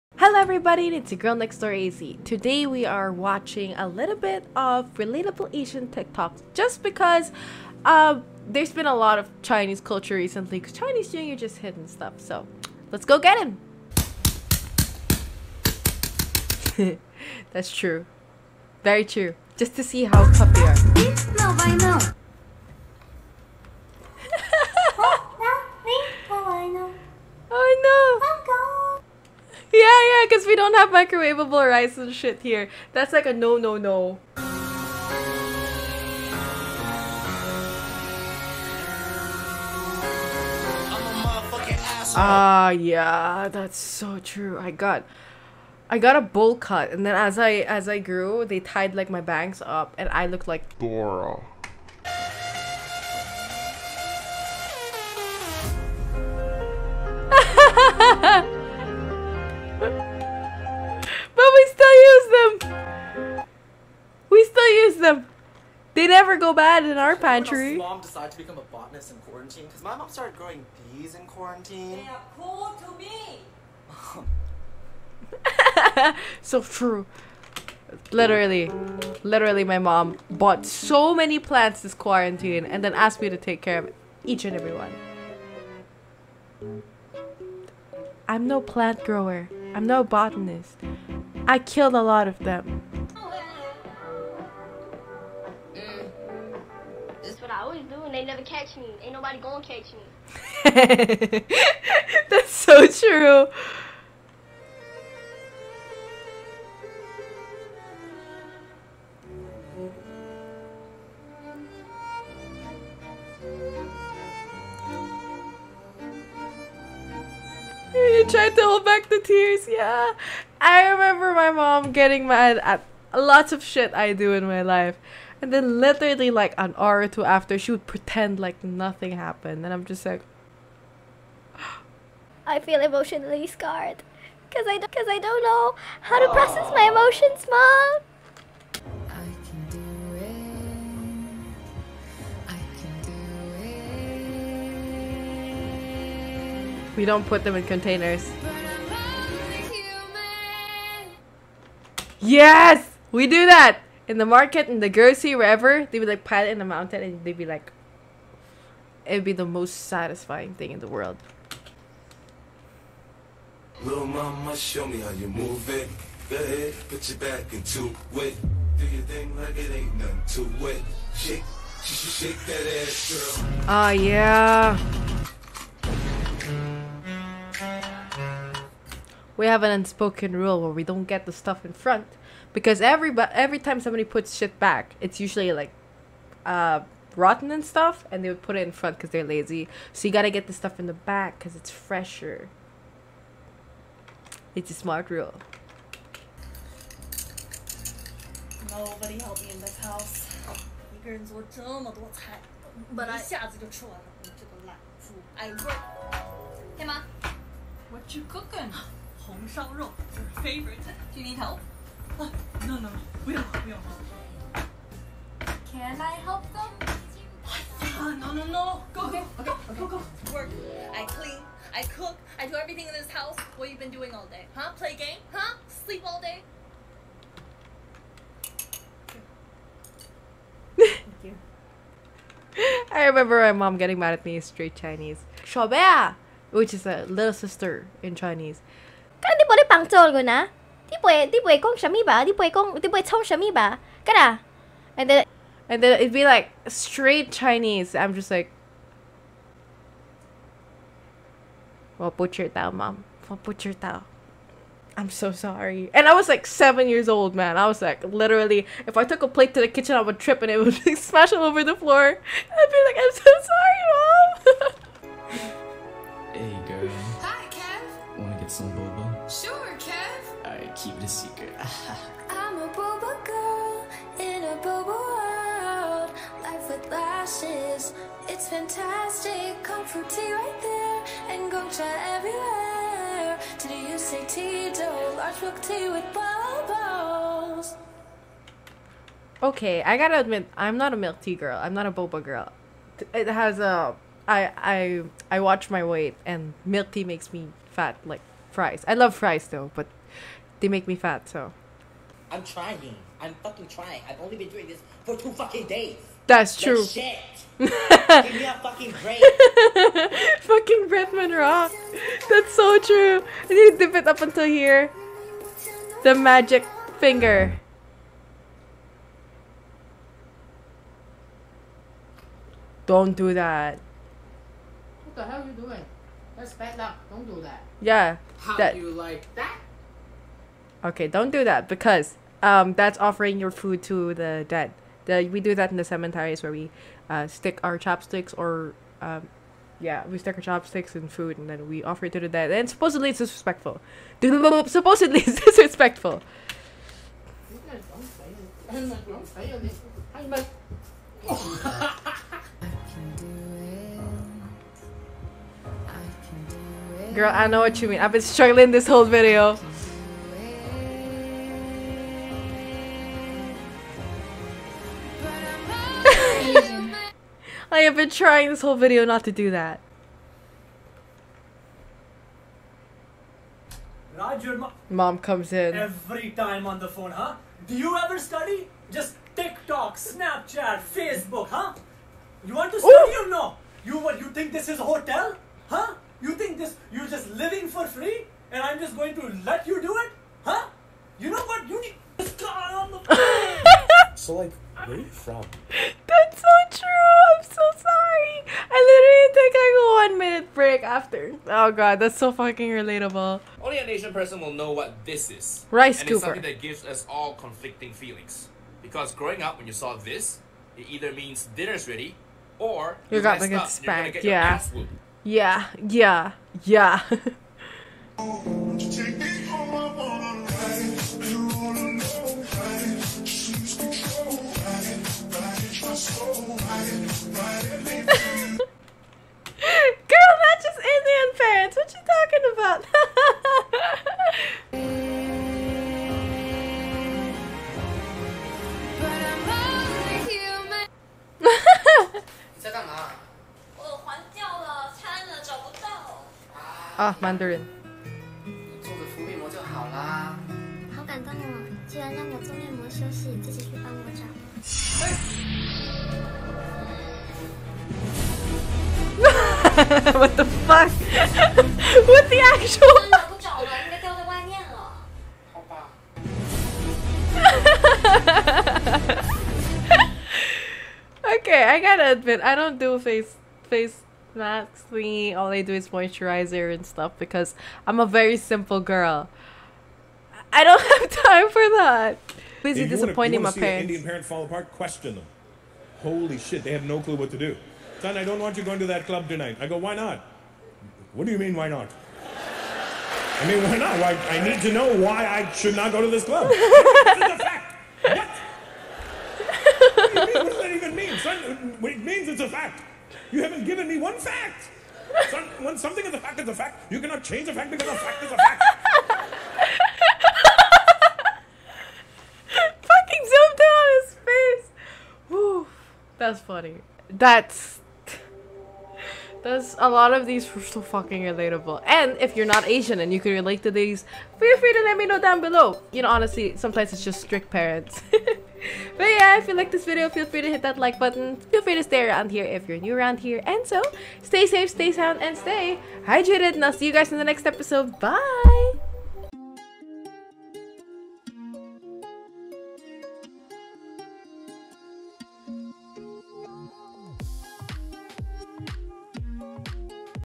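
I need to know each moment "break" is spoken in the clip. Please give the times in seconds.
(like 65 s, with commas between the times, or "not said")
309 s, 400 s.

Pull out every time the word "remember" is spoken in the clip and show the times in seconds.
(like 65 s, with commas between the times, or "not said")
120 s, 233 s.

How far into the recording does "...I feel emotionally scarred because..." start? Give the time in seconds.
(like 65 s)
132 s.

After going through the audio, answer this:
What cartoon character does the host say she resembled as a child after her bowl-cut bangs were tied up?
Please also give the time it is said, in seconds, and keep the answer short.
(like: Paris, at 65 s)
Dora, at 50 s.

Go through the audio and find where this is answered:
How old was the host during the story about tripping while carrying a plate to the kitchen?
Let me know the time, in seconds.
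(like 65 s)
256 s.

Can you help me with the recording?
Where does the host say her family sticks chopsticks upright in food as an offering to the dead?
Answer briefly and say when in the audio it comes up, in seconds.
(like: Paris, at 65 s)
Cemeteries, at 335 s.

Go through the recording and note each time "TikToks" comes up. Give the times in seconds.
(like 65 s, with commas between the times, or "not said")
5 s, 379 s.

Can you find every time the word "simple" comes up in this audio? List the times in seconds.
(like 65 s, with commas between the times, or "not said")
478 s.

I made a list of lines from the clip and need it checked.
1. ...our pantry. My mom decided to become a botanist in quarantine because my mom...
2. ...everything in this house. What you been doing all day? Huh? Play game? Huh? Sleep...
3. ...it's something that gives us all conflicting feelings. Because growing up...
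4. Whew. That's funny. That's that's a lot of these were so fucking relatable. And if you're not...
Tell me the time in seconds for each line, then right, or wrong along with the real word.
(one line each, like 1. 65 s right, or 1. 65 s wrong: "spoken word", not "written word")
1. 66 s right
2. 222 s right
3. 406 s right
4. 515 s right.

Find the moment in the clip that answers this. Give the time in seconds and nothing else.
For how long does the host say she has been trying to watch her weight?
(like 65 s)
305 s.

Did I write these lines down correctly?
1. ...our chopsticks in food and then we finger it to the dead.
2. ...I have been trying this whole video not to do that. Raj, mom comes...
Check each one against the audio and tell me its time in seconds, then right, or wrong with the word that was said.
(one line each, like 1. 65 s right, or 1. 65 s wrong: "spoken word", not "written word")
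1. 340 s wrong: "offer", not "finger"
2. 367 s right.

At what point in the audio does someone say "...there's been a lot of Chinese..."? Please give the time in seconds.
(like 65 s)
8 s.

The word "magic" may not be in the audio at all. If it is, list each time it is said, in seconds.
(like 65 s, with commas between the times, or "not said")
316 s.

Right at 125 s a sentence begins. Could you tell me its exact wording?
And then literally like an hour or two after, she would pretend like nothing happened.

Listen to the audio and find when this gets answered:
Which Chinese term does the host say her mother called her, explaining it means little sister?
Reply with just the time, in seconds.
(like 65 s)
235 s.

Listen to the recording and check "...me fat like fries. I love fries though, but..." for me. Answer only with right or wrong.
right.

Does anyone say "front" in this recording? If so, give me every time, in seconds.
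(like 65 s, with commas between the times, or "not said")
181 s, 188 s.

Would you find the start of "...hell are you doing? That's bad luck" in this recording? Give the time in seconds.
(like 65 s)
325 s.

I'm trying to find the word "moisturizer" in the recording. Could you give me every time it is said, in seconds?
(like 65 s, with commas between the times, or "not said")
475 s.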